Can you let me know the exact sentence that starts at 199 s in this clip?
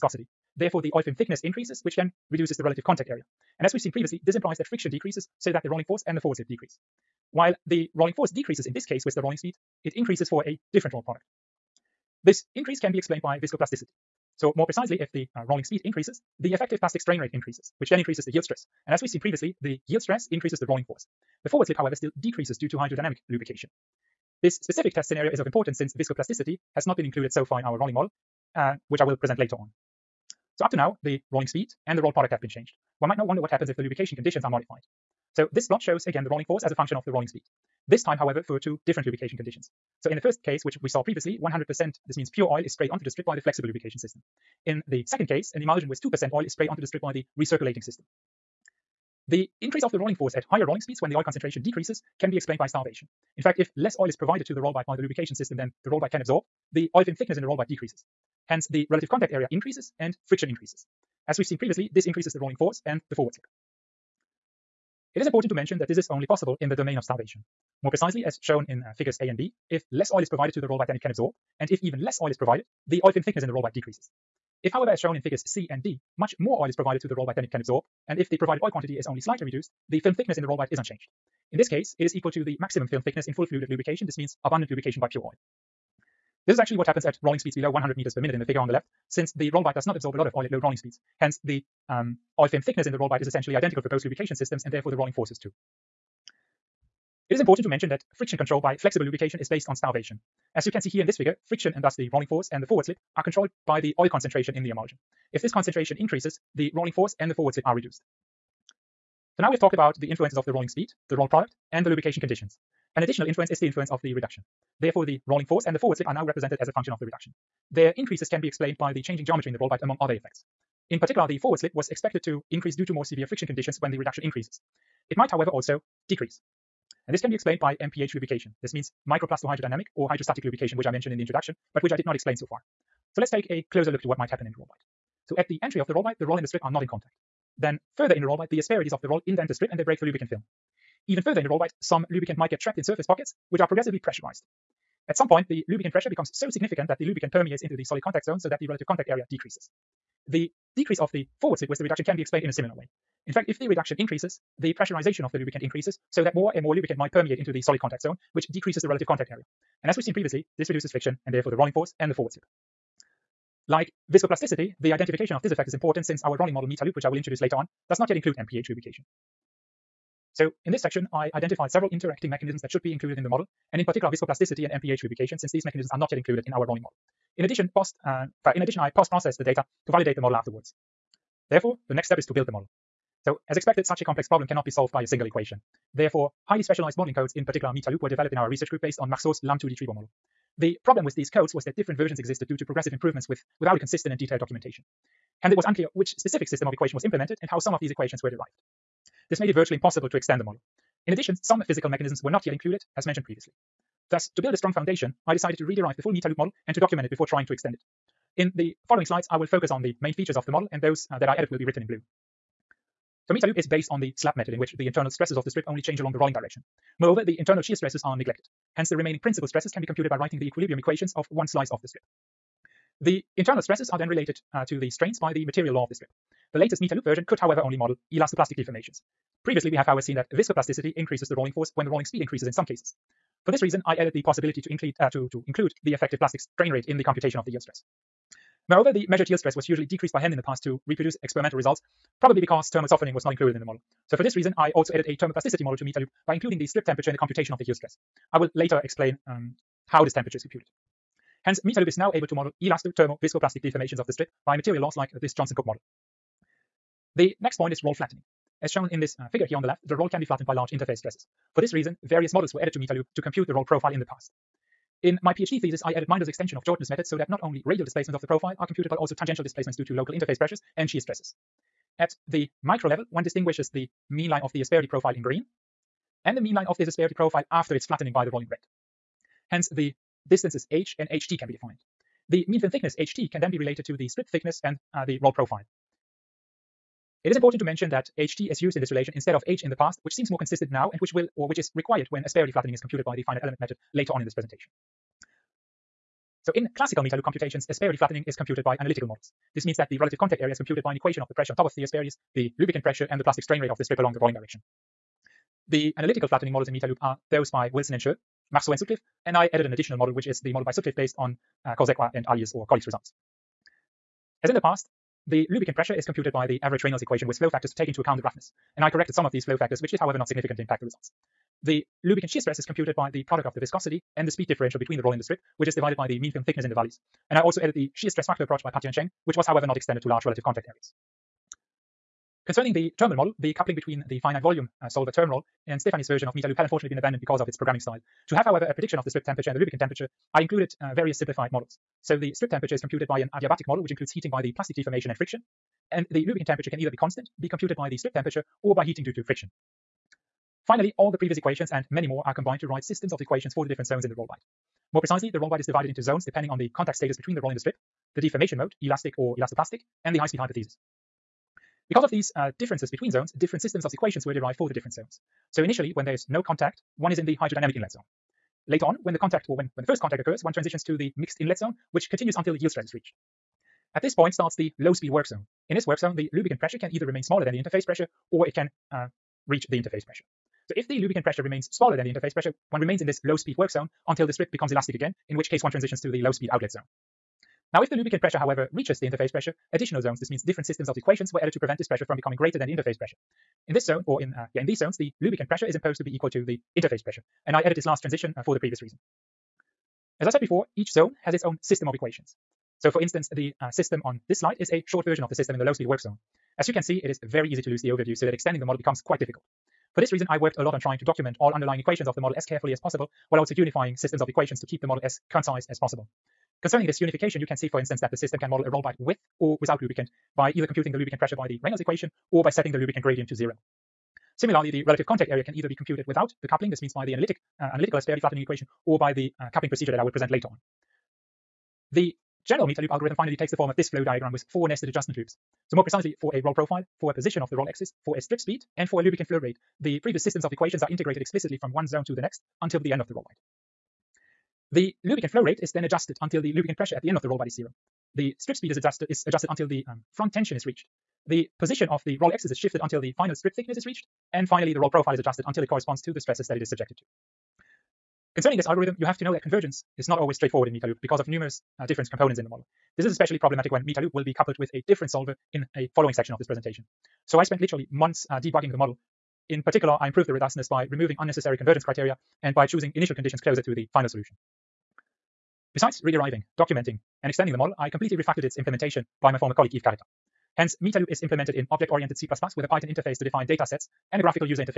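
This made it virtually impossible to extend the model.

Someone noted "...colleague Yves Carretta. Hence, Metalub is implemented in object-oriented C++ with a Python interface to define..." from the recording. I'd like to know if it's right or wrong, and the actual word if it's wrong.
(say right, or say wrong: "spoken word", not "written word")
right.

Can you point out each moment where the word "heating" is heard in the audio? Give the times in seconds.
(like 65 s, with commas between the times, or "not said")
344 s, 348 s.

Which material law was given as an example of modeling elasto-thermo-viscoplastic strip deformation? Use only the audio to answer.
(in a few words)
Johnson-Cook model.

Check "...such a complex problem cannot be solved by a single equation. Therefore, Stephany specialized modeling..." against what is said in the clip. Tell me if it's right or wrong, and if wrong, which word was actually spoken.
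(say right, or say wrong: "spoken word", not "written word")
wrong: "Highly", not "Stephany".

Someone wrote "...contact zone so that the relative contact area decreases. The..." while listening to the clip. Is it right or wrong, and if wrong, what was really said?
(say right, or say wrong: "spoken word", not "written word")
right.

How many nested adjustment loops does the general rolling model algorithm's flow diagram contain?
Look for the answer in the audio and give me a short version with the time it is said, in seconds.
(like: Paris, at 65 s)
4, at 434 s.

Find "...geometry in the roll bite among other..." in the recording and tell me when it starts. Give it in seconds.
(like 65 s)
119 s.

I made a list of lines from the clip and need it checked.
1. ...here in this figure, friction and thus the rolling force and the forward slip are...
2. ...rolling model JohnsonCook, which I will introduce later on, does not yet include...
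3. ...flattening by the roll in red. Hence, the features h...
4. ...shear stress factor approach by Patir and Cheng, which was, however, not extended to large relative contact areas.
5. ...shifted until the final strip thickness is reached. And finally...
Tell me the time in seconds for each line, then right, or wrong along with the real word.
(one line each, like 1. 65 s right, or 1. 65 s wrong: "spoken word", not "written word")
1. 100 s right
2. 166 s wrong: "Metalub", not "JohnsonCook"
3. 277 s wrong: "distances", not "features"
4. 327 s right
5. 452 s right.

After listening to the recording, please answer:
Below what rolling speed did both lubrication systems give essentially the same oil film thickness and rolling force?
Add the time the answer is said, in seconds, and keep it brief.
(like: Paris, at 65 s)
100 meters per minute, at 87 s.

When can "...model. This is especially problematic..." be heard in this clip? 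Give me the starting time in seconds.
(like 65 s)
462 s.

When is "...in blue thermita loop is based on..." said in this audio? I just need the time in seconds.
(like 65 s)
211 s.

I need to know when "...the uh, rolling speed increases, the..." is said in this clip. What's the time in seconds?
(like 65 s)
15 s.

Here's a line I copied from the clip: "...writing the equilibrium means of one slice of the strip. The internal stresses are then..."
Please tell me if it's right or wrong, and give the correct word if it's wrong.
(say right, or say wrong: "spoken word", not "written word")
wrong: "equations", not "means".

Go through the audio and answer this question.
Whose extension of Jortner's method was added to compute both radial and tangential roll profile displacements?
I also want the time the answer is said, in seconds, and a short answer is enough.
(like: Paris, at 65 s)
Minder, at 266 s.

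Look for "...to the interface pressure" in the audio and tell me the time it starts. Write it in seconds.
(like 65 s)
396 s.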